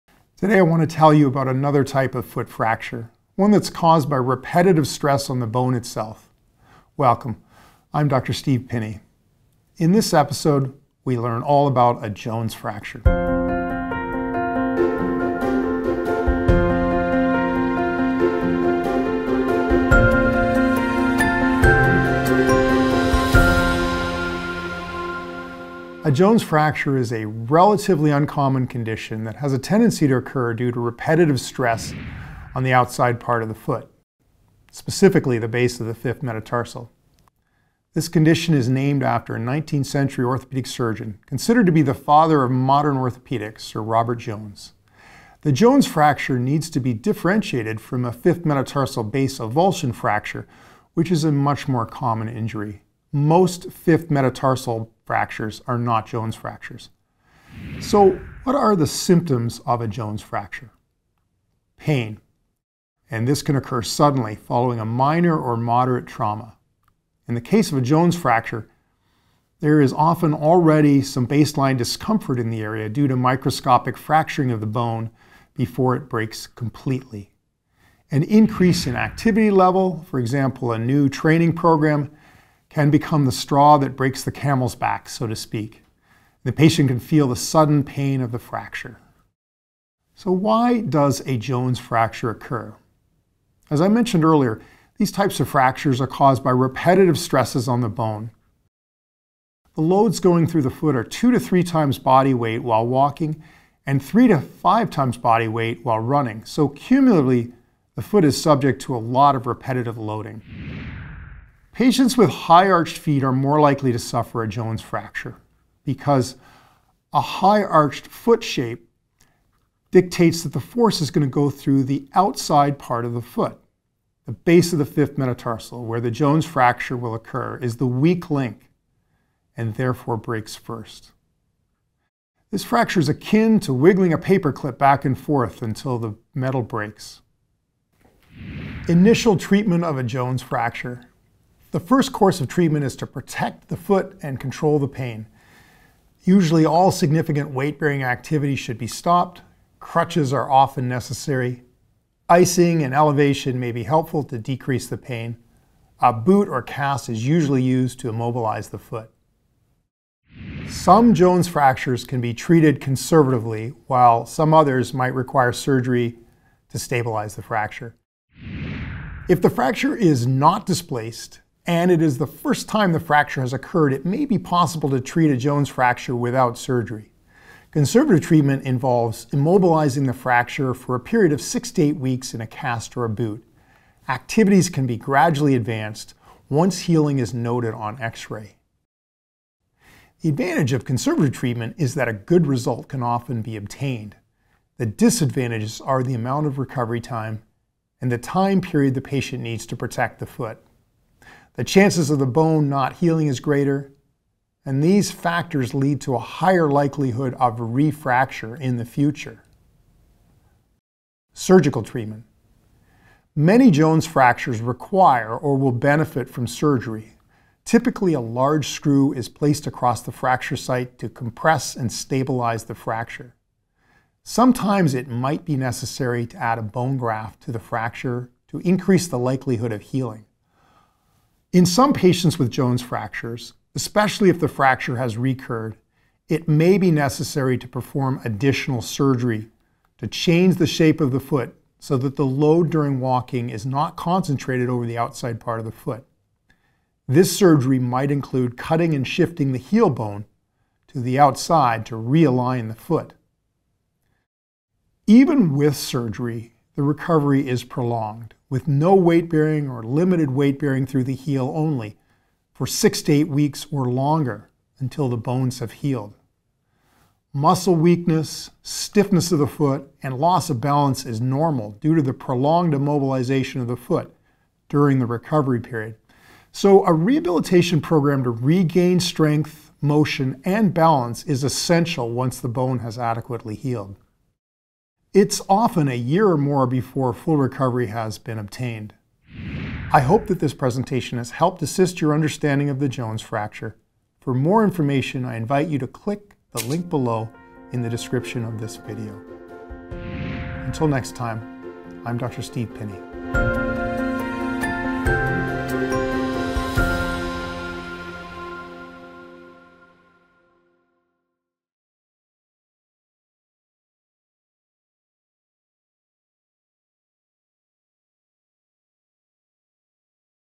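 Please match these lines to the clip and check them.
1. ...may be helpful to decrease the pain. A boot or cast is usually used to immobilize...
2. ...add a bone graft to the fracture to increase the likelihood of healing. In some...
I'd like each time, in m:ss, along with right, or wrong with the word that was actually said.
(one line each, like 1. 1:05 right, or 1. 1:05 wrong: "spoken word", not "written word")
1. 2:33 right
2. 3:46 right.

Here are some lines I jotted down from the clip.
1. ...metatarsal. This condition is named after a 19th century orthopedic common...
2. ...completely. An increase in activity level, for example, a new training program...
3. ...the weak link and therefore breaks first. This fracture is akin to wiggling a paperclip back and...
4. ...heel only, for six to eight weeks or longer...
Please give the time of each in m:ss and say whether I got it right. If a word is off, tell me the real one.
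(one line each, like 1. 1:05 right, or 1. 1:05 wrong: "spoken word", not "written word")
1. 0:36 wrong: "surgeon", not "common"
2. 1:16 right
3. 2:07 right
4. 4:21 right.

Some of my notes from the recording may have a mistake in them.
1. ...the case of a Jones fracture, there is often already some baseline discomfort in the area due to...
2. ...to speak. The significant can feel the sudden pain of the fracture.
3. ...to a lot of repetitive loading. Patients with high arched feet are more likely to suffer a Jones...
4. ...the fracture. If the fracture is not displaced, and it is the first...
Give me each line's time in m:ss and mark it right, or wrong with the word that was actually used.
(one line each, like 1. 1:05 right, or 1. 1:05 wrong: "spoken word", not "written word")
1. 1:07 right
2. 1:25 wrong: "patient", not "significant"
3. 1:48 right
4. 2:47 right.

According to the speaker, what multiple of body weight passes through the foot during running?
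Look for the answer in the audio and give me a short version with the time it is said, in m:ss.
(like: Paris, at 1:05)
3 to 5 times, at 1:44.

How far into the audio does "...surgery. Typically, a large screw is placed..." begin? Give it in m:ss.
3:36.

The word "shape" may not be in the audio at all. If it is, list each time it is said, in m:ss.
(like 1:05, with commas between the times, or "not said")
1:58, 4:00.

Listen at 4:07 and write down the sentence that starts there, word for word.
This surgery might include cutting and shifting the heel bone to the outside to realign the foot.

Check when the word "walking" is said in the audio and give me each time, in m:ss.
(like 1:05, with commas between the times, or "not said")
1:42, 4:03.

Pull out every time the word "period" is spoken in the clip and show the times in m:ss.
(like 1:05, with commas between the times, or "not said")
3:00, 3:18, 4:35.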